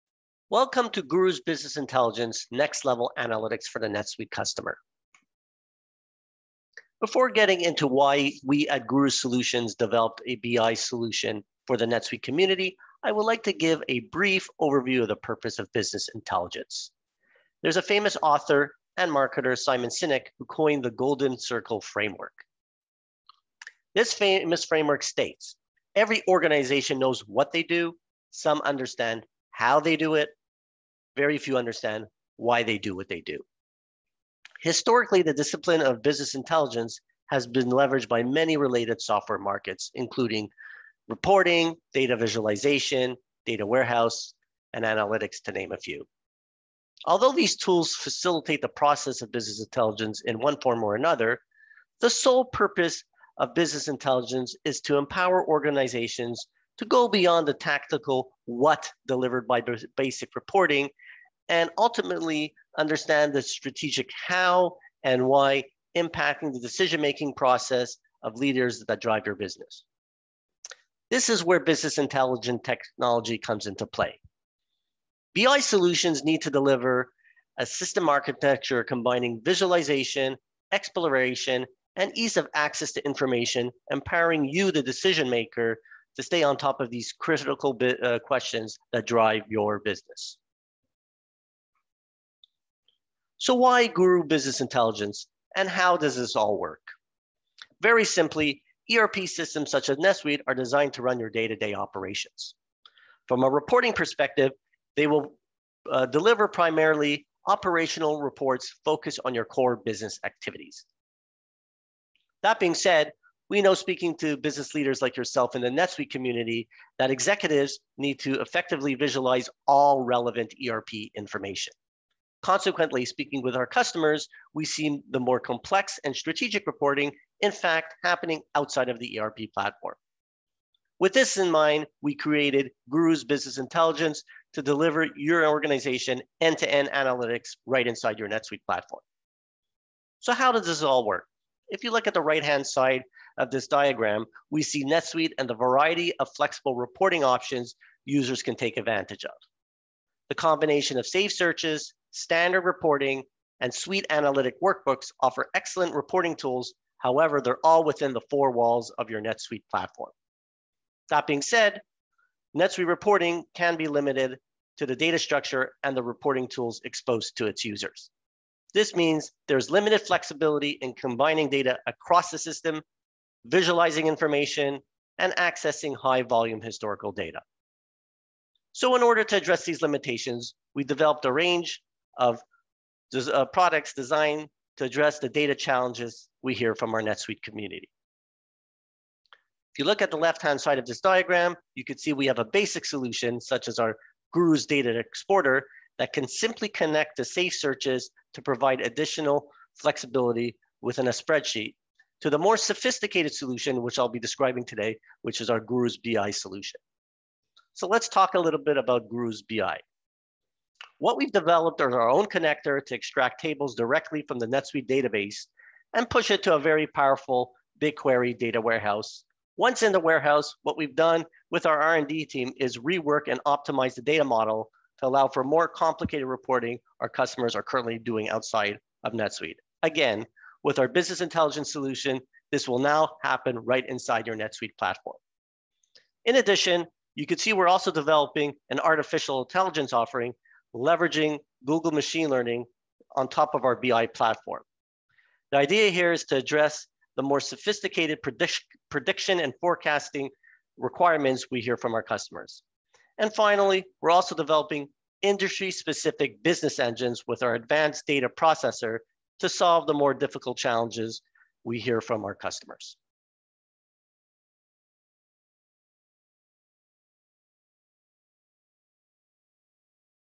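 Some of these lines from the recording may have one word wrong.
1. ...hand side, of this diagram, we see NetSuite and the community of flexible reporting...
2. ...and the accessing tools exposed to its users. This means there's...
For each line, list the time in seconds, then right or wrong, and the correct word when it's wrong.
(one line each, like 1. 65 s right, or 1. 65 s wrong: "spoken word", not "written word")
1. 142 s wrong: "variety", not "community"
2. 165 s wrong: "reporting", not "accessing".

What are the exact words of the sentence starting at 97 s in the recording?
Very simply, ERP systems such as NetSuite are designed to run your day-to-day -day operations.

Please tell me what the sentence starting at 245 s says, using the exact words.
The idea here is to address the more sophisticated predict prediction and forecasting requirements we hear from our customers.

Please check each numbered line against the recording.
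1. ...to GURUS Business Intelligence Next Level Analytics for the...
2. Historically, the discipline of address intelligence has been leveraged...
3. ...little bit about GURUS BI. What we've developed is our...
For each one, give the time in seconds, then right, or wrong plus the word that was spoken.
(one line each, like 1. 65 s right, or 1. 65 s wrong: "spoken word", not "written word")
1. 0 s right
2. 34 s wrong: "business", not "address"
3. 208 s right.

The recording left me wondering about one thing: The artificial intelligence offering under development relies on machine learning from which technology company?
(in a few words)
Google.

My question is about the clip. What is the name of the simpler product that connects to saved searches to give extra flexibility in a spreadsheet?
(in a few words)
GURUS data exporter.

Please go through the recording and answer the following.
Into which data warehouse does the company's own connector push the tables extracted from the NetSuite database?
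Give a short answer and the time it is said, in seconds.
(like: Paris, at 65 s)
BigQuery, at 217 s.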